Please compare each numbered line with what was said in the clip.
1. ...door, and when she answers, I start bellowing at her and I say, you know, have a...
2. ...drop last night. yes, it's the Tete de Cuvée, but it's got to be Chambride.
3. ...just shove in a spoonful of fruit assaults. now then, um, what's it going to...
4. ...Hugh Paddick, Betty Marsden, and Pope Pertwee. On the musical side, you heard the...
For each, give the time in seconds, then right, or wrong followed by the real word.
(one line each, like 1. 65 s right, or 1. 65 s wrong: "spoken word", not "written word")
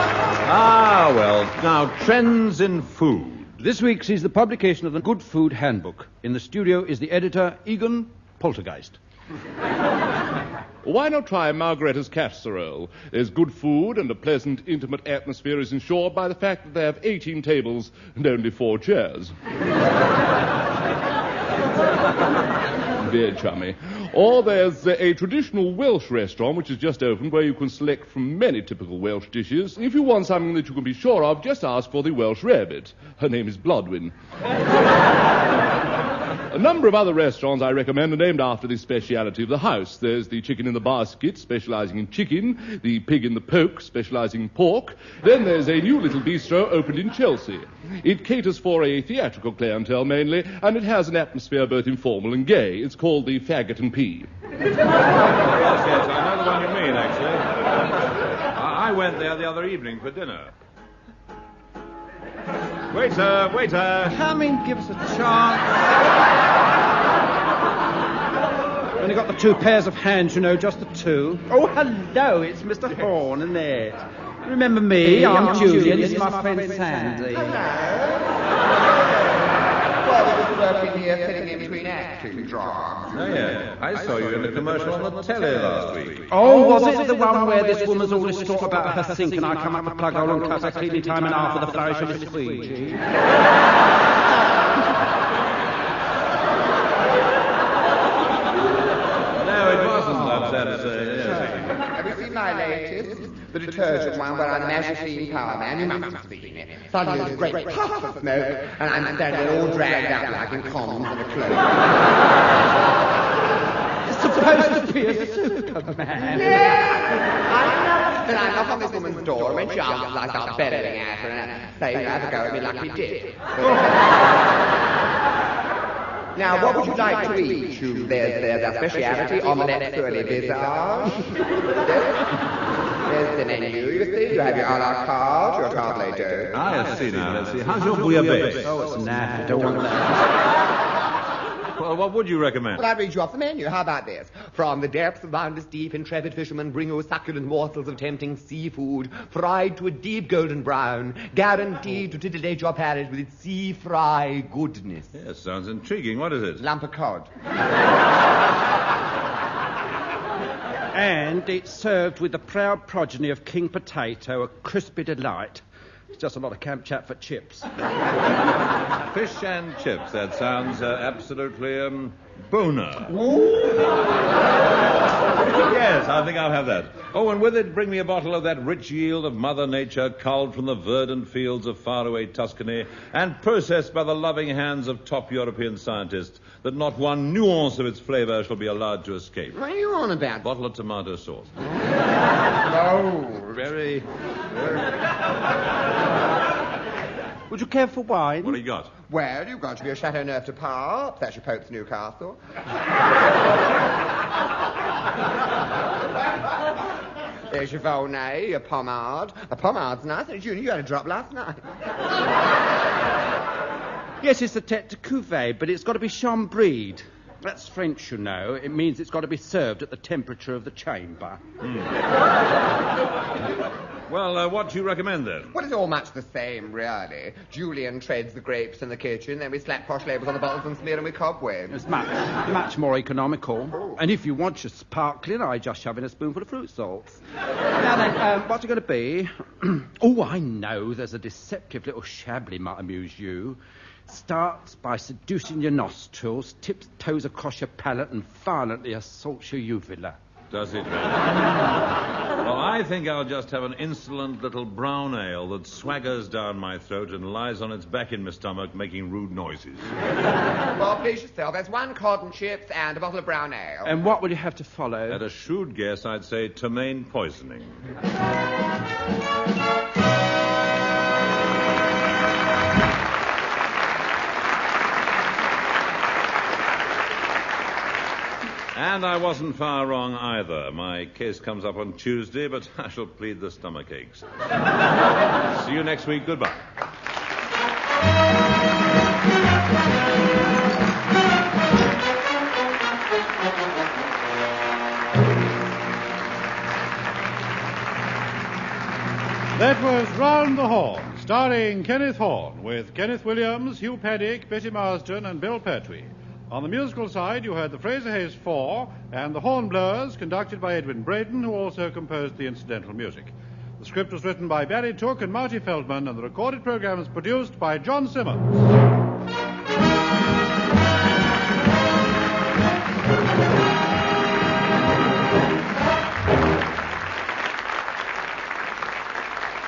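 1. 119 s right
2. 210 s right
3. 235 s wrong: "salts", not "assaults"
4. 303 s wrong: "Bill", not "Pope".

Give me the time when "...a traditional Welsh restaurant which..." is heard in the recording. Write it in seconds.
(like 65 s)
24 s.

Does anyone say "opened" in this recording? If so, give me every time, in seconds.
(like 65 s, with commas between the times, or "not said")
27 s, 46 s.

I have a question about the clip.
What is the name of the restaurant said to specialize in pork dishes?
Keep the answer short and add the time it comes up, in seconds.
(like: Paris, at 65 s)
The Pig in the Poke, at 42 s.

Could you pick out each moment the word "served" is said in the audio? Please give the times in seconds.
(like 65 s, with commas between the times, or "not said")
161 s, 219 s.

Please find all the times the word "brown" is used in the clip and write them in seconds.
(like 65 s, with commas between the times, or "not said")
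150 s, 254 s, 263 s.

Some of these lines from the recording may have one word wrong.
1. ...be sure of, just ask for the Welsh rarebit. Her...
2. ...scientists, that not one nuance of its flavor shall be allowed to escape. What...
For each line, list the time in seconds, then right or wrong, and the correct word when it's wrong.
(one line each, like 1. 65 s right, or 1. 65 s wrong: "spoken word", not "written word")
1. 30 s right
2. 185 s right.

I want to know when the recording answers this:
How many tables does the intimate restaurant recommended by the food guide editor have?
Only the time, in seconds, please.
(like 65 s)
17 s.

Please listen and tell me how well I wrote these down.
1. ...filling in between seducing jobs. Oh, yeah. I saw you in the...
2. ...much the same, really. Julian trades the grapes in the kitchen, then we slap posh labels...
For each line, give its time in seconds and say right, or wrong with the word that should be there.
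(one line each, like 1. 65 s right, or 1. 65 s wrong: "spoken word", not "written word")
1. 81 s wrong: "acting", not "seducing"
2. 225 s right.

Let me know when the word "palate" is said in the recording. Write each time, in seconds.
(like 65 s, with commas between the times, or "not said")
152 s, 247 s.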